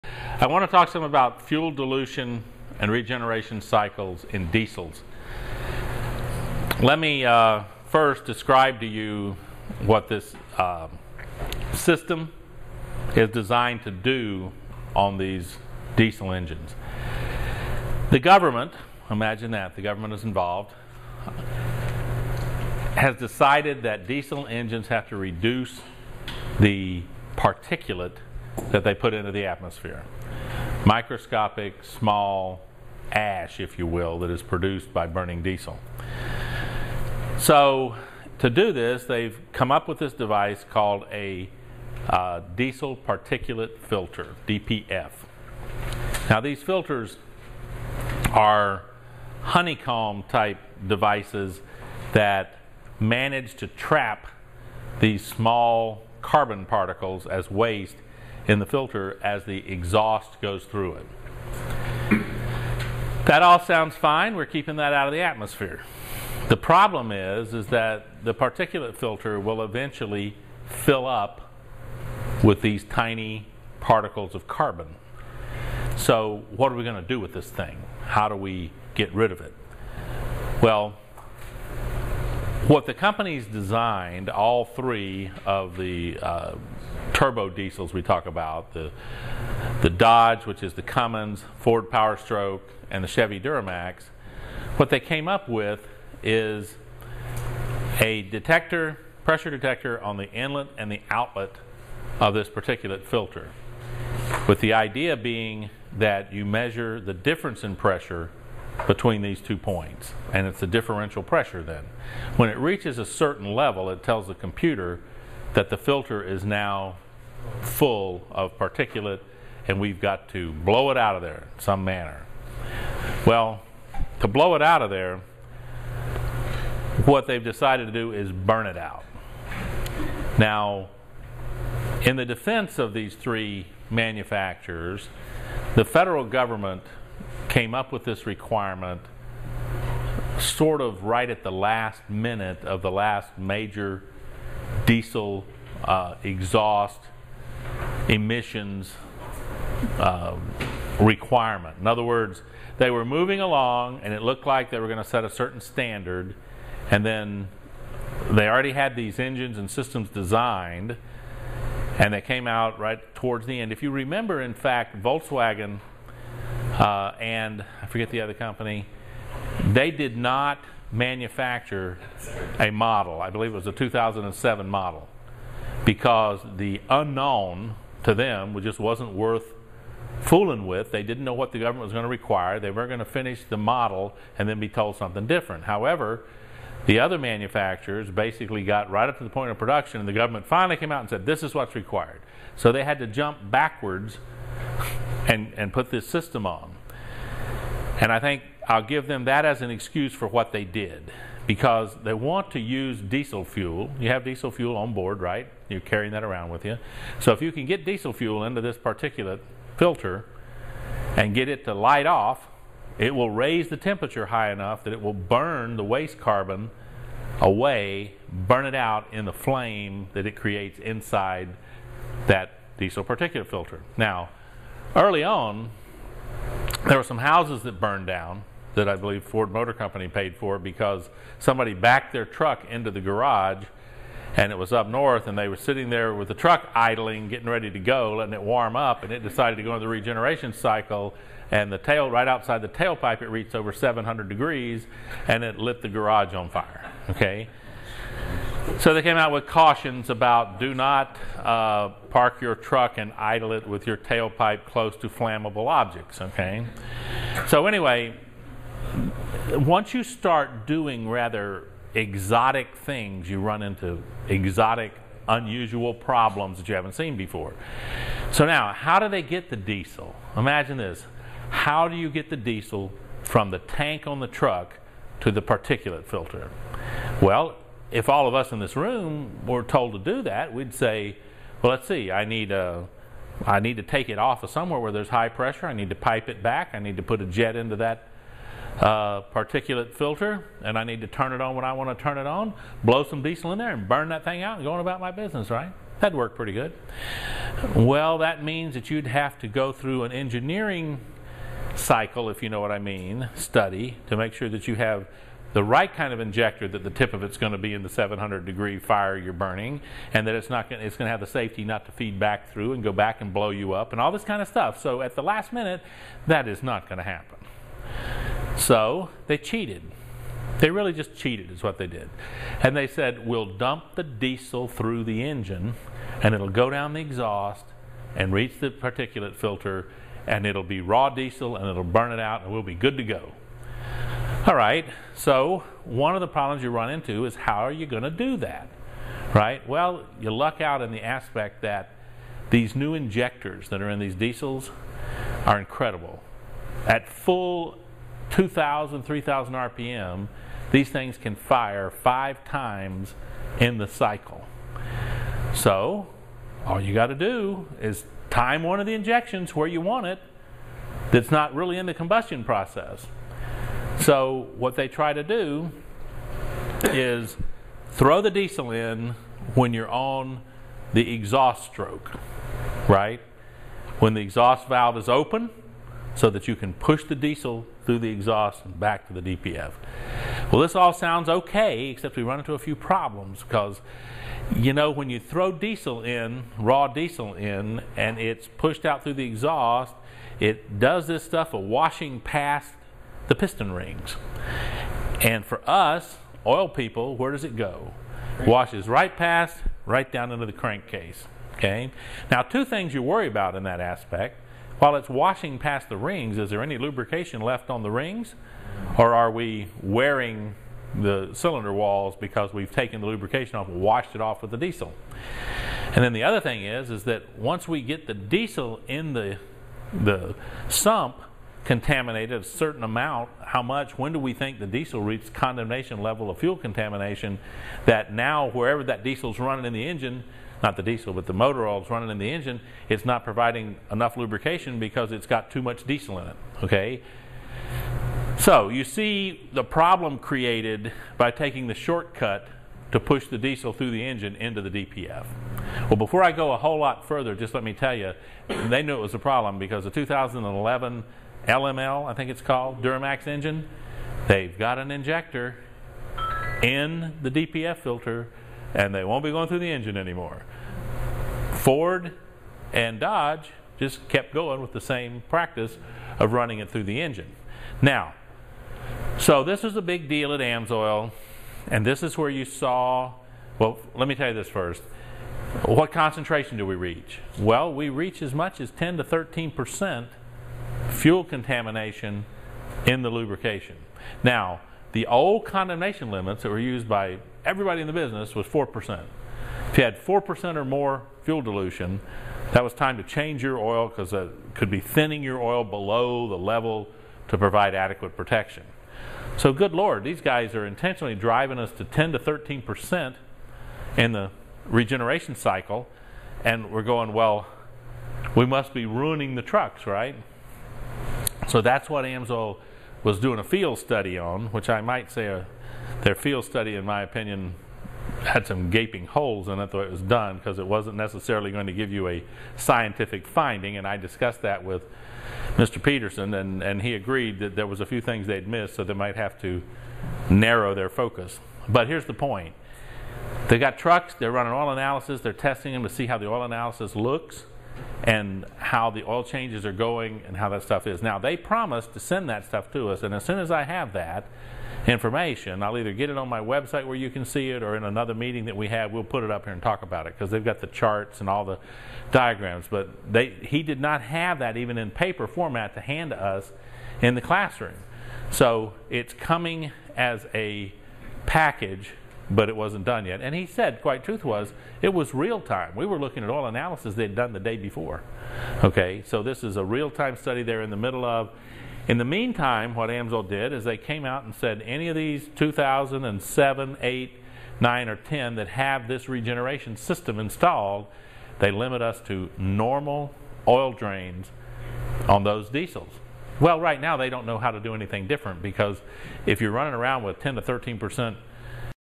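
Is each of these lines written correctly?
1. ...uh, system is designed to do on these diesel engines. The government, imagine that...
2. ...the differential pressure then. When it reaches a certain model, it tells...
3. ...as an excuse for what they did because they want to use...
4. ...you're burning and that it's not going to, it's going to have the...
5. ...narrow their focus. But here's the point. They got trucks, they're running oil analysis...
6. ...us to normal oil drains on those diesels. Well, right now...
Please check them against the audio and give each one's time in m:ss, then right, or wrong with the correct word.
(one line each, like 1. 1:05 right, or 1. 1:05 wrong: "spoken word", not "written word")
1. 0:10 right
2. 1:50 wrong: "level", not "model"
3. 3:19 right
4. 5:09 right
5. 8:50 right
6. 9:41 right.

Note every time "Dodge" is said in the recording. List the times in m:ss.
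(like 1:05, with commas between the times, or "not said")
1:29, 7:42.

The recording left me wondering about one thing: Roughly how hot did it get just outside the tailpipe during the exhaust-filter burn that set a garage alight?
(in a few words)
over 700 degrees.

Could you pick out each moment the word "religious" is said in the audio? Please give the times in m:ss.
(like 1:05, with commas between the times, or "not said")
not said.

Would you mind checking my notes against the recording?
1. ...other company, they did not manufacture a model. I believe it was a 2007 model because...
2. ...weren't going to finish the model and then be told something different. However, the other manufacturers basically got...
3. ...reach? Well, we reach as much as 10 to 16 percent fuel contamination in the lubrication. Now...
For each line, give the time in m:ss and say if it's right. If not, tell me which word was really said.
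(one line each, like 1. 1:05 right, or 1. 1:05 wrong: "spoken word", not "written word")
1. 2:48 right
2. 3:02 right
3. 7:56 wrong: "13", not "16".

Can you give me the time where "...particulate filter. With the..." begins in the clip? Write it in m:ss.
1:42.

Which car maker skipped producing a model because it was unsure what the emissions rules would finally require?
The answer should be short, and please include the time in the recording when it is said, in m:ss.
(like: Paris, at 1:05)
Volkswagen, at 2:45.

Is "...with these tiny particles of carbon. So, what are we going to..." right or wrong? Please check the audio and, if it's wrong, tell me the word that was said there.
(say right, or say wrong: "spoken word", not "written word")
right.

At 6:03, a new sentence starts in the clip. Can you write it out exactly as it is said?
So, what they try to do is throw the diesel in when you're on the exhaust stroke, right?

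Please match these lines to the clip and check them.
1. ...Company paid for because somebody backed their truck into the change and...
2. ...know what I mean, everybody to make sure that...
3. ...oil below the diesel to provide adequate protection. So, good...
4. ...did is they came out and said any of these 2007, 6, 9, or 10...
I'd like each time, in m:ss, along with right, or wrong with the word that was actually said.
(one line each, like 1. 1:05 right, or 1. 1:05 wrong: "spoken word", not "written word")
1. 3:49 wrong: "garage", not "change"
2. 5:02 wrong: "study", not "everybody"
3. 8:15 wrong: "level", not "diesel"
4. 9:33 wrong: "8", not "6".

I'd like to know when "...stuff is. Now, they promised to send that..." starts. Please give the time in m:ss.
9:00.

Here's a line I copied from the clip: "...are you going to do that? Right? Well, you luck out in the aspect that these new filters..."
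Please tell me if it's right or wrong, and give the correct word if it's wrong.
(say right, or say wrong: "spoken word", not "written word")
wrong: "injectors", not "filters".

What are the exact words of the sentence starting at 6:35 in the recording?
And for us, oil people, where does it go?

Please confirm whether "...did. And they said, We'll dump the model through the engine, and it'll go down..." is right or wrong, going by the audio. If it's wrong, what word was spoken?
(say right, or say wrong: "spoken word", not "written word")
wrong: "diesel", not "model".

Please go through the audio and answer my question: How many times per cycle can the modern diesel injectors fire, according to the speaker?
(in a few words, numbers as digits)
5.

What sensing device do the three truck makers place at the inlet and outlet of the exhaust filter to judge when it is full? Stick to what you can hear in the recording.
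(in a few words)
pressure detector.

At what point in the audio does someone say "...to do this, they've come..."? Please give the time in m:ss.
0:38.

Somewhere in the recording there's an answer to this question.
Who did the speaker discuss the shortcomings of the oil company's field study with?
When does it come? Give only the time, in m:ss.
8:45.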